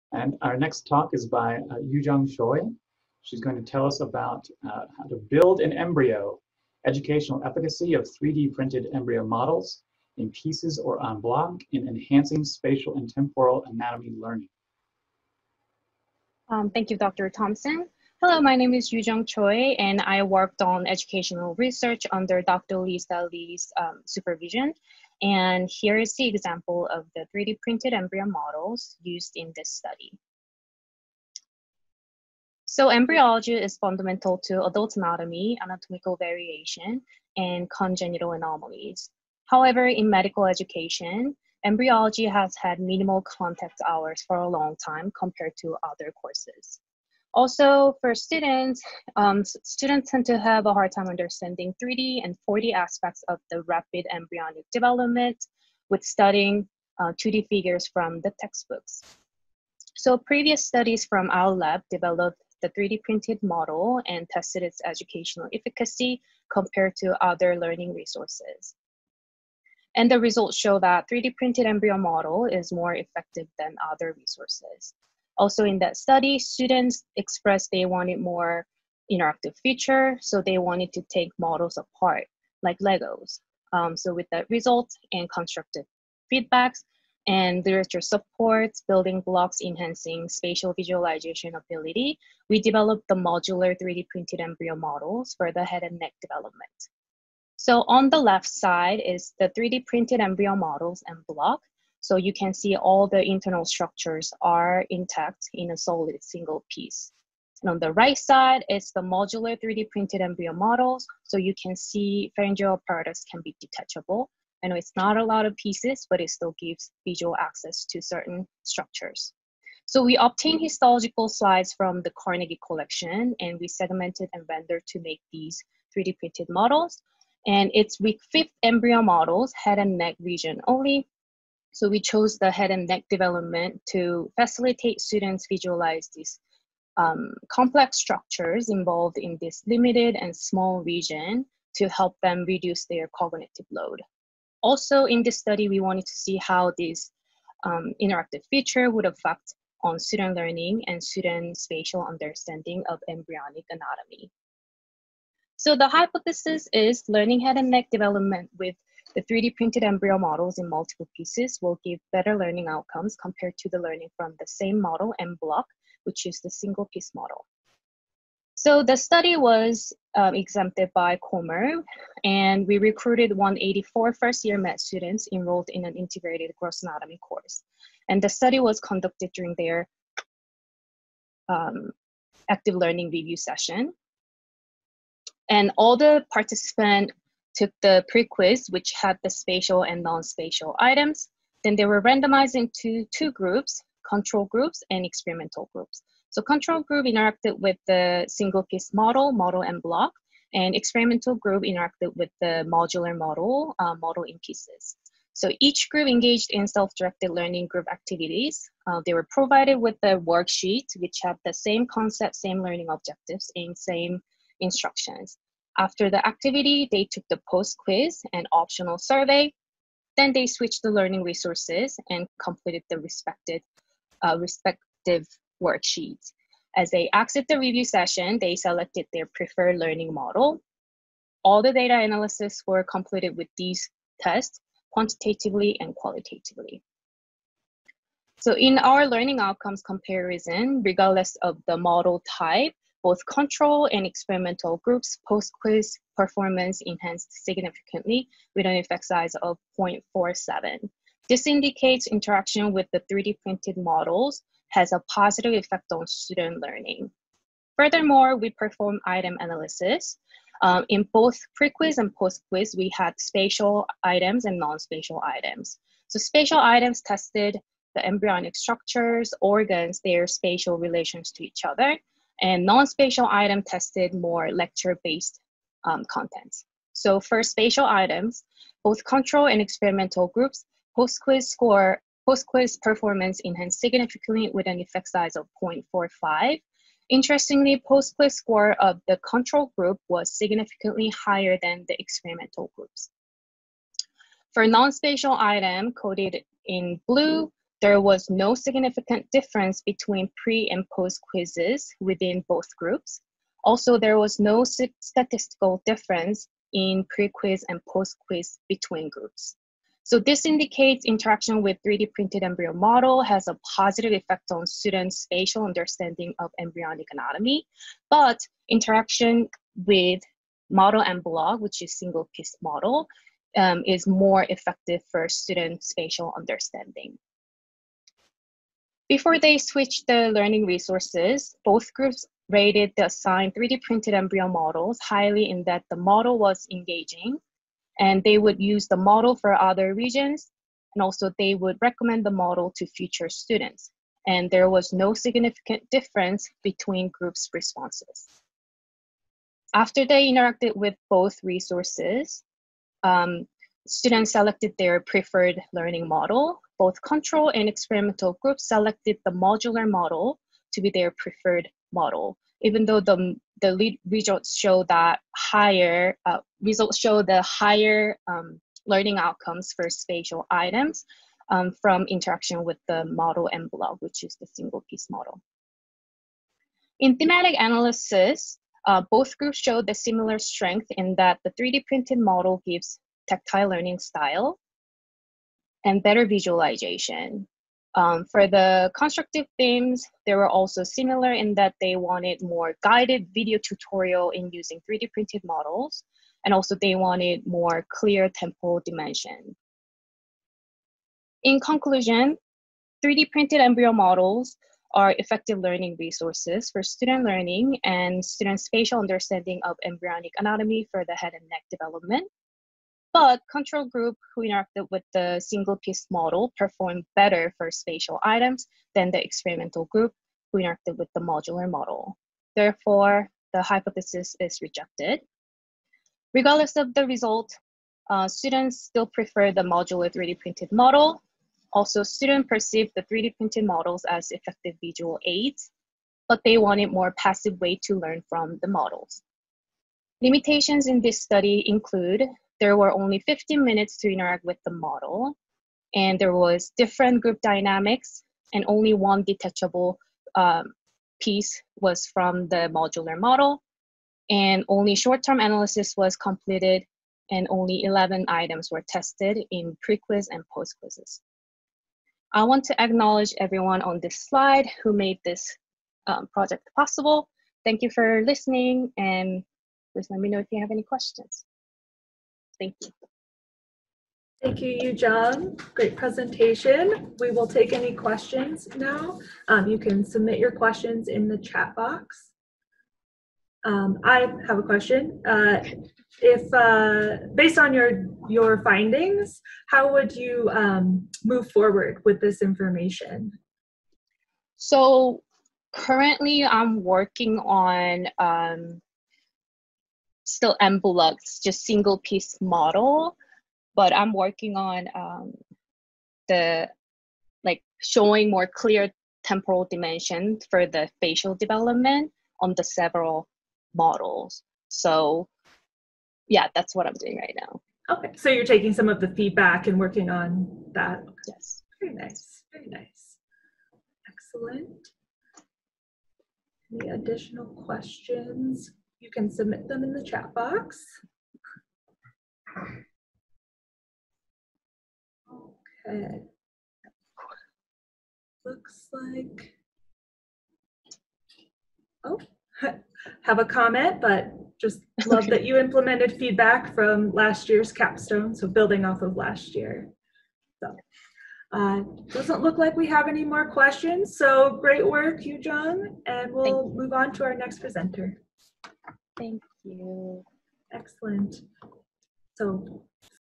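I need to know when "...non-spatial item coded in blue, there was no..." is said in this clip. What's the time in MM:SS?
04:54.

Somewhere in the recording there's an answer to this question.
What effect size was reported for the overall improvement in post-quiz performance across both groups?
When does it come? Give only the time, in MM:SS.
04:09.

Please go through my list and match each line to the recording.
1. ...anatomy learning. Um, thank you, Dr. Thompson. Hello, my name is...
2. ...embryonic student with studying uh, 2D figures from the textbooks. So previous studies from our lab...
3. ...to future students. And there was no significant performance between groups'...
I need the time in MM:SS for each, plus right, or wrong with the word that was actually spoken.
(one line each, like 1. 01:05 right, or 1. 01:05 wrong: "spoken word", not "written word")
1. 00:13 right
2. 00:54 wrong: "development", not "student"
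3. 05:42 wrong: "difference", not "performance".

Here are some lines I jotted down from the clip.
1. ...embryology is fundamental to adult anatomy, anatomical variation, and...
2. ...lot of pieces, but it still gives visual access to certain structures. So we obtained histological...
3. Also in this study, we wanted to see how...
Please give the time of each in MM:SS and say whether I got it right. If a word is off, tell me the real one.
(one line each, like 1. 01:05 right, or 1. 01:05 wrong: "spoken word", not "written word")
1. 00:32 right
2. 01:55 right
3. 02:24 right.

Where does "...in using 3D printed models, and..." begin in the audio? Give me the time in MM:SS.
06:34.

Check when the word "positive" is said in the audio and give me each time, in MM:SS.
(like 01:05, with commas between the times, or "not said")
04:15, 05:13.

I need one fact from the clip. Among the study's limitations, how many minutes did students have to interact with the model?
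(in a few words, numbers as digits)
15.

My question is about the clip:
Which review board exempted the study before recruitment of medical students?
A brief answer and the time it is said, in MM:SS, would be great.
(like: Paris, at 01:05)
COMIRB, at 02:51.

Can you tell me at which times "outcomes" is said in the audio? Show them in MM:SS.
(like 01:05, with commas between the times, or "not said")
02:42, 03:59, 06:09.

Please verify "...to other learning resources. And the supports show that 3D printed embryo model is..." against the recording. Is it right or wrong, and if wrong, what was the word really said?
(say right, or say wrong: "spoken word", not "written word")
wrong: "results", not "supports".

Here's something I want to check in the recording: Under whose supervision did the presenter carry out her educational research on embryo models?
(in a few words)
Dr. Lisa Lee.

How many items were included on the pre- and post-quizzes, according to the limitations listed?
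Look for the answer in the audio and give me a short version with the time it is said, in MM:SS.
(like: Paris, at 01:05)
11, at 07:37.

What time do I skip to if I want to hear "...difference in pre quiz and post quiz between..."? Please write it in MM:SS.
05:05.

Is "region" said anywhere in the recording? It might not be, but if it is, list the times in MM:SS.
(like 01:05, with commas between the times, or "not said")
02:10, 02:20, 05:39.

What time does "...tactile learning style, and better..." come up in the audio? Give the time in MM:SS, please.
06:23.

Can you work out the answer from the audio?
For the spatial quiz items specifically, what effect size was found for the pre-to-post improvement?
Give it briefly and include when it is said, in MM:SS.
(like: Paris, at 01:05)
0.45, at 04:45.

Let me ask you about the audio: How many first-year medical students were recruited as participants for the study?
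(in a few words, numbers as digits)
184.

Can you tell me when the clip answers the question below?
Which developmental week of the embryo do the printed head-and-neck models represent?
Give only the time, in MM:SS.
02:07.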